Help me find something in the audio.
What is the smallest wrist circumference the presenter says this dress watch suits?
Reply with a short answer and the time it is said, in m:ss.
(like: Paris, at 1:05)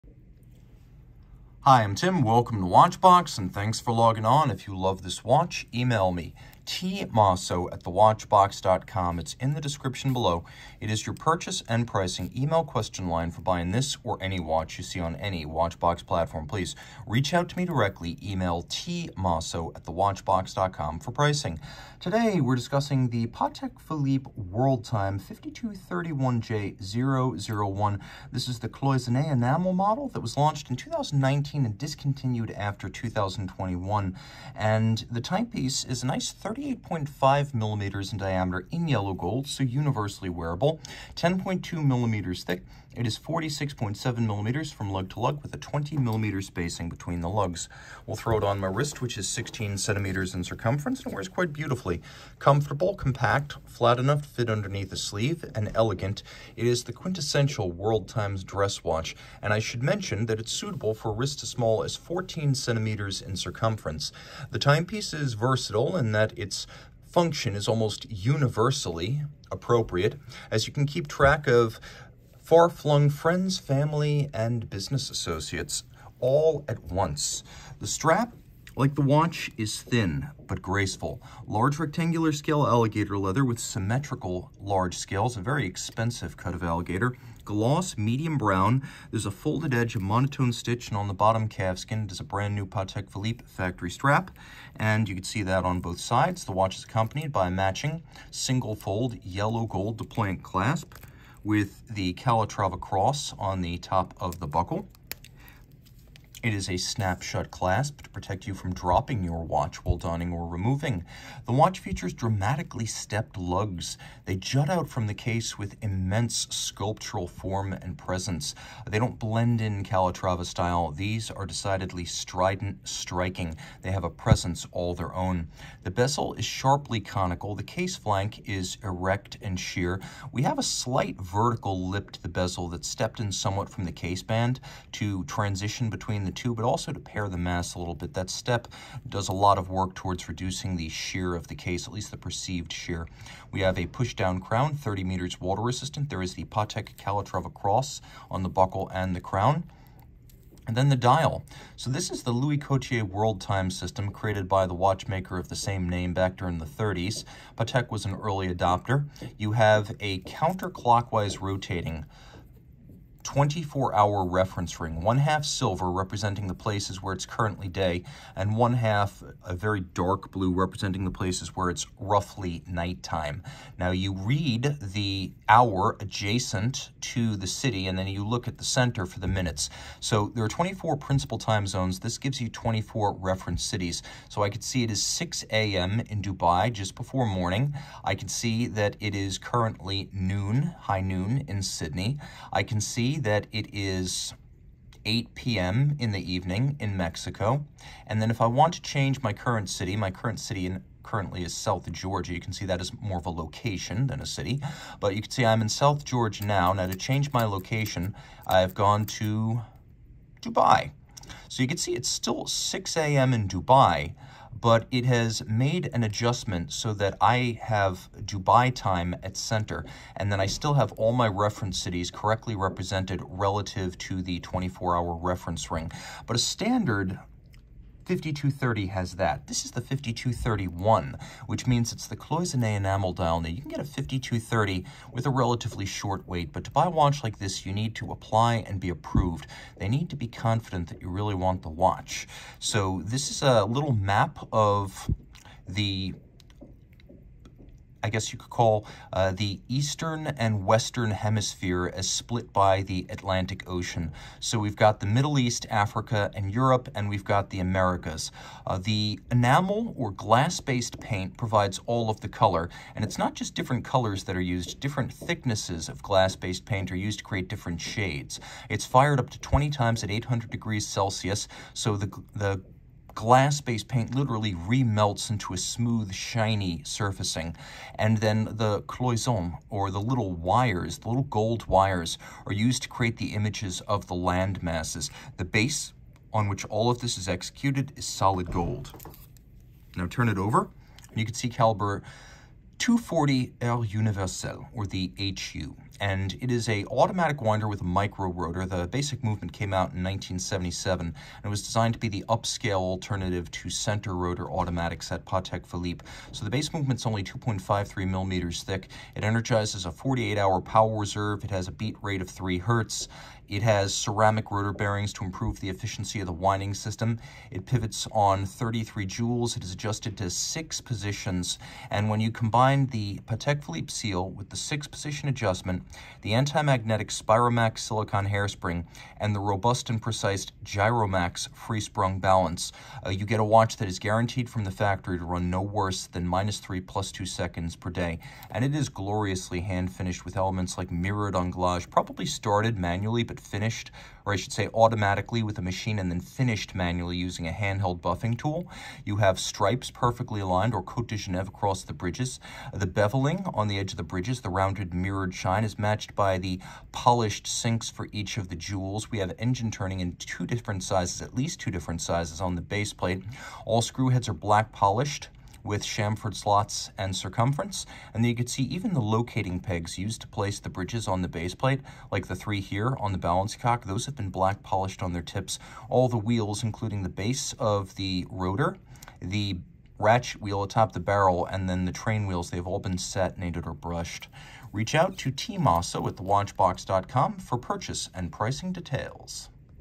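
14 centimeters, at 1:01.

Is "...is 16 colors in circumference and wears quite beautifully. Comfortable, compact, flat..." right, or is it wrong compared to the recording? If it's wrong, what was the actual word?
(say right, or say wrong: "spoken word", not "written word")
wrong: "centimeters", not "colors".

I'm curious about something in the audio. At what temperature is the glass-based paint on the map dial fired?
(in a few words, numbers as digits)
800 degrees Celsius.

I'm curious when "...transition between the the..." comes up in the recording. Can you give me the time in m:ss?
2:15.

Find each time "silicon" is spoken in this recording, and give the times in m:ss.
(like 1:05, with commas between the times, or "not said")
5:27.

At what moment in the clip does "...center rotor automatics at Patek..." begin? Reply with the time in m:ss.
5:03.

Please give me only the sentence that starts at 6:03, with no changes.
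All screw heads are black polished with chamfered slots and circumference.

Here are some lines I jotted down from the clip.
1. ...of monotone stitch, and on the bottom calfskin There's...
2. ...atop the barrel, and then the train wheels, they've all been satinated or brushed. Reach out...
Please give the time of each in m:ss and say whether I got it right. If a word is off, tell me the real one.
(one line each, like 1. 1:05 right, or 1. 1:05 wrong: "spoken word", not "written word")
1. 1:29 right
2. 6:20 right.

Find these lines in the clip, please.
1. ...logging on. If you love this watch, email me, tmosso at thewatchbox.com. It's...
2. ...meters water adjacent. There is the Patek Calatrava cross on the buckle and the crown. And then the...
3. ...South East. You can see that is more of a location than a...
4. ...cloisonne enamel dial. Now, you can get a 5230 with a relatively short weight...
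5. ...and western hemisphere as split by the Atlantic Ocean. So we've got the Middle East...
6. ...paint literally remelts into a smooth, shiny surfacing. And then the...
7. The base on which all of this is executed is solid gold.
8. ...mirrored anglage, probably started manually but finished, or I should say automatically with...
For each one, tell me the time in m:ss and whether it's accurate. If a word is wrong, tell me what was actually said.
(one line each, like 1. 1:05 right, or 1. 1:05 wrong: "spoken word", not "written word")
1. 0:03 right
2. 2:25 wrong: "resistant", not "adjacent"
3. 3:21 wrong: "Georgia", not "East"
4. 3:52 right
5. 4:10 right
6. 4:33 right
7. 4:45 right
8. 5:40 right.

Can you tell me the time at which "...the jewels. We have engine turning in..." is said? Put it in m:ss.
5:58.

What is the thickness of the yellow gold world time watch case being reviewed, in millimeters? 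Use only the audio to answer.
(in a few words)
10.2 millimeters.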